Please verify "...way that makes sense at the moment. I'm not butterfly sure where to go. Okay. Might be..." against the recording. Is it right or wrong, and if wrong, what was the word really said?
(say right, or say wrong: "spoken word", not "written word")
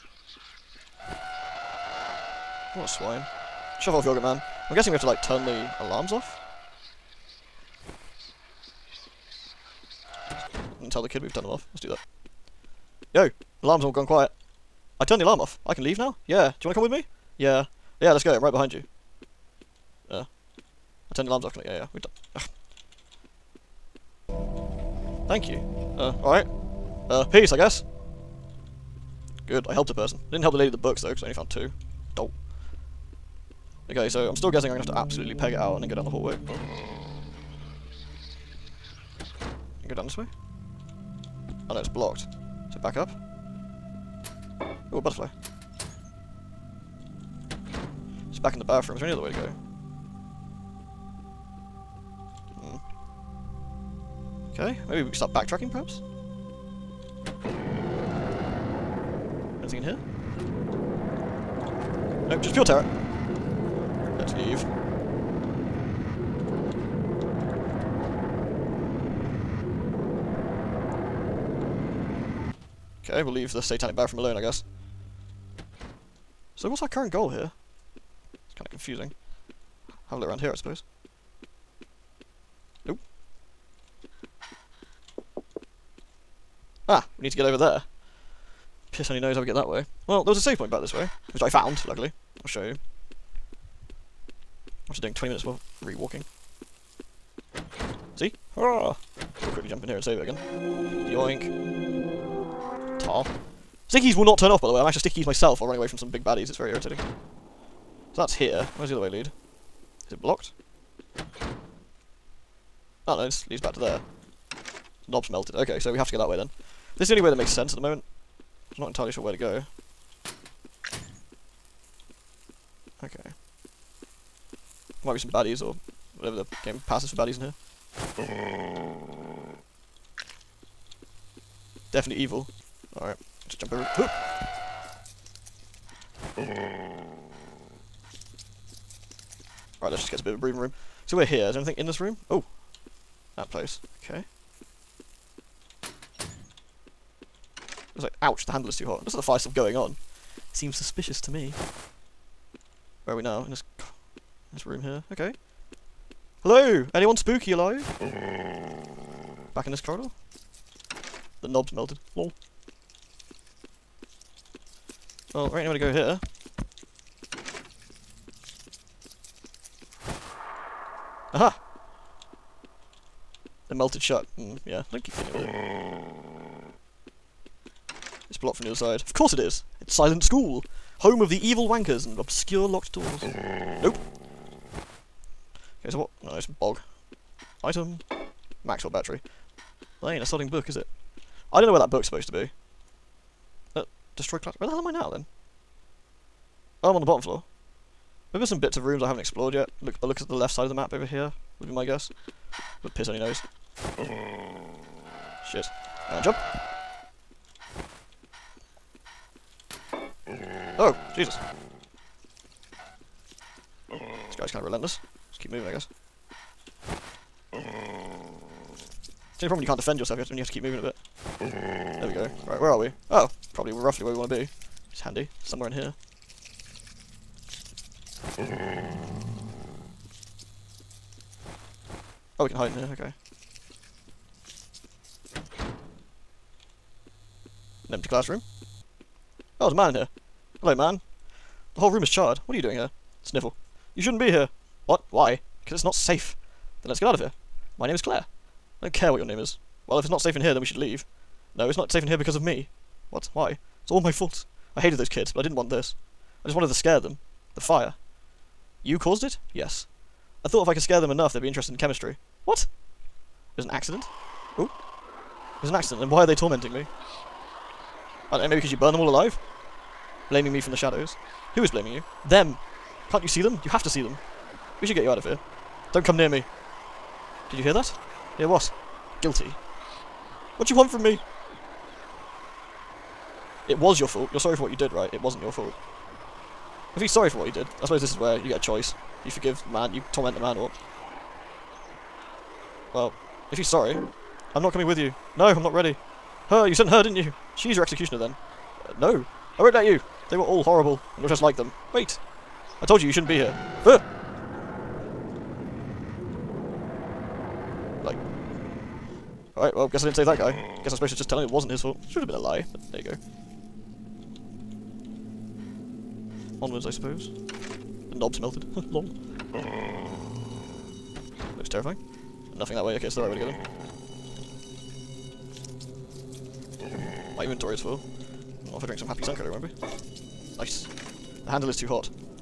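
wrong: "entirely", not "butterfly".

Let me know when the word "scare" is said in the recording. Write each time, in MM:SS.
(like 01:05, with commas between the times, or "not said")
04:16, 04:20.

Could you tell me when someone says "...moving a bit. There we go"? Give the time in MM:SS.
03:40.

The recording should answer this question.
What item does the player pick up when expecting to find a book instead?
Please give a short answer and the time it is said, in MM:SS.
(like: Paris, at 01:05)
Maxwell battery, at 03:08.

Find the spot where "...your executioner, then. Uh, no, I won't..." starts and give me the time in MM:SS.
04:57.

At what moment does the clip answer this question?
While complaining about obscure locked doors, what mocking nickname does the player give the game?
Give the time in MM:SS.
02:59.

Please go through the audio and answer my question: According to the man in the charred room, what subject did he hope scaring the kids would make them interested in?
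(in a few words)
Chemistry.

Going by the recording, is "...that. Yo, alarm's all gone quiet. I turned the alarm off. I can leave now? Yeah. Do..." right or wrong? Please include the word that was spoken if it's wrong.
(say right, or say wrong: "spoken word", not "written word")
right.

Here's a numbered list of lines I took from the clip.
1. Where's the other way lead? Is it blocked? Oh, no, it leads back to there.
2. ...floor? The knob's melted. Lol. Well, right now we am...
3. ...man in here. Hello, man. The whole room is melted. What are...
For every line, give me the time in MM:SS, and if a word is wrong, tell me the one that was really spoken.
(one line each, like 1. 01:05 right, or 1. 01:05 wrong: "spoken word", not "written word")
1. 01:48 right
2. 02:39 wrong: "corridor", not "floor"
3. 03:59 wrong: "charred", not "melted".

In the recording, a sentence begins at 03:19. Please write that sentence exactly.
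Look, but look at the left side of the map over here.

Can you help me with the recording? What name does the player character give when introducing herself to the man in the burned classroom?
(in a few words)
Claire.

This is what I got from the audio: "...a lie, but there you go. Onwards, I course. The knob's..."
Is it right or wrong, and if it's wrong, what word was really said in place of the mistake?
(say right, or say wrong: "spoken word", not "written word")
wrong: "suppose", not "course".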